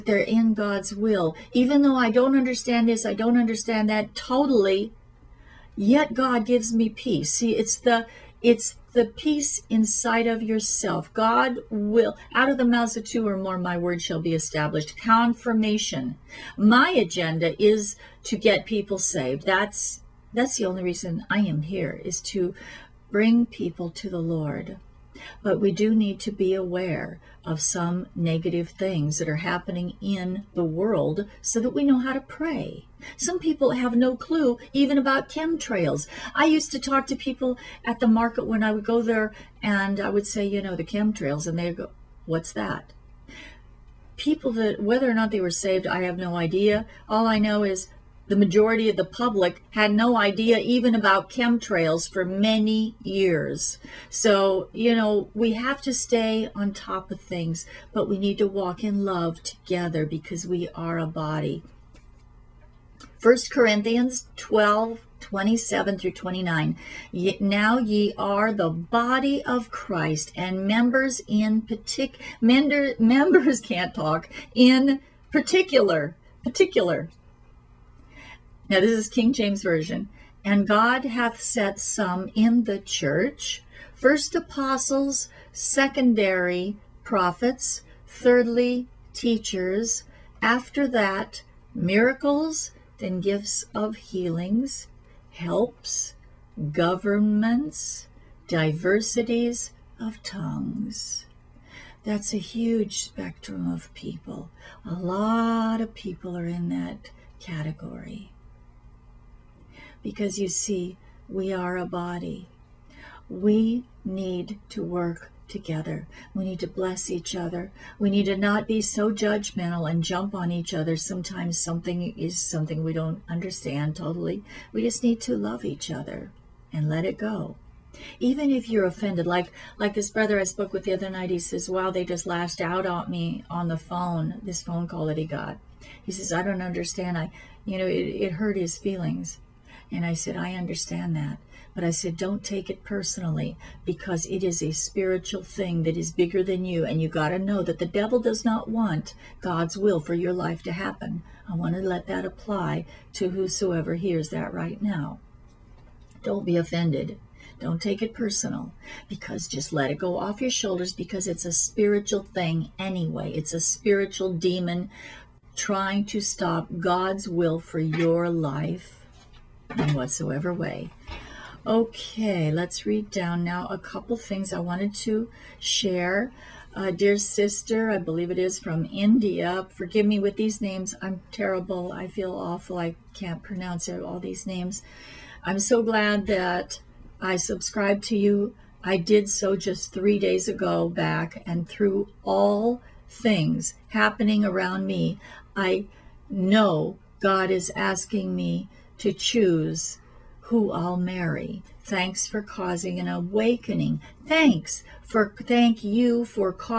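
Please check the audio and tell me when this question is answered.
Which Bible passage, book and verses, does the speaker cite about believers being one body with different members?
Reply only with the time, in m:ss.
1:03.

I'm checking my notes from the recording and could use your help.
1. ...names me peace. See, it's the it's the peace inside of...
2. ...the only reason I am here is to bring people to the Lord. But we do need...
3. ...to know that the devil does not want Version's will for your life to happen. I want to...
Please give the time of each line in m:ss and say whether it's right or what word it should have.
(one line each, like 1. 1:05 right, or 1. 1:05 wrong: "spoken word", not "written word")
1. 0:06 wrong: "gives", not "names"
2. 0:20 right
3. 2:27 wrong: "God", not "Version".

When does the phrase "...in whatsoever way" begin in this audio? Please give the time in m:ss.
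2:49.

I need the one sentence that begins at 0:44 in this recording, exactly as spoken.
People that, whether or not they were saved, I have no idea.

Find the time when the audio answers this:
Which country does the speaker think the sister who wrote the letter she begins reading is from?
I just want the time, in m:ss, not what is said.
2:58.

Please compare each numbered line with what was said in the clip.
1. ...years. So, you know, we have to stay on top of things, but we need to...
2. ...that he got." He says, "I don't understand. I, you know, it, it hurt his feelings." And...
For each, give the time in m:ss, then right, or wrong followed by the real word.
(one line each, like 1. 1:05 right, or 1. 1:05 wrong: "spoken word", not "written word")
1. 0:53 right
2. 2:15 right.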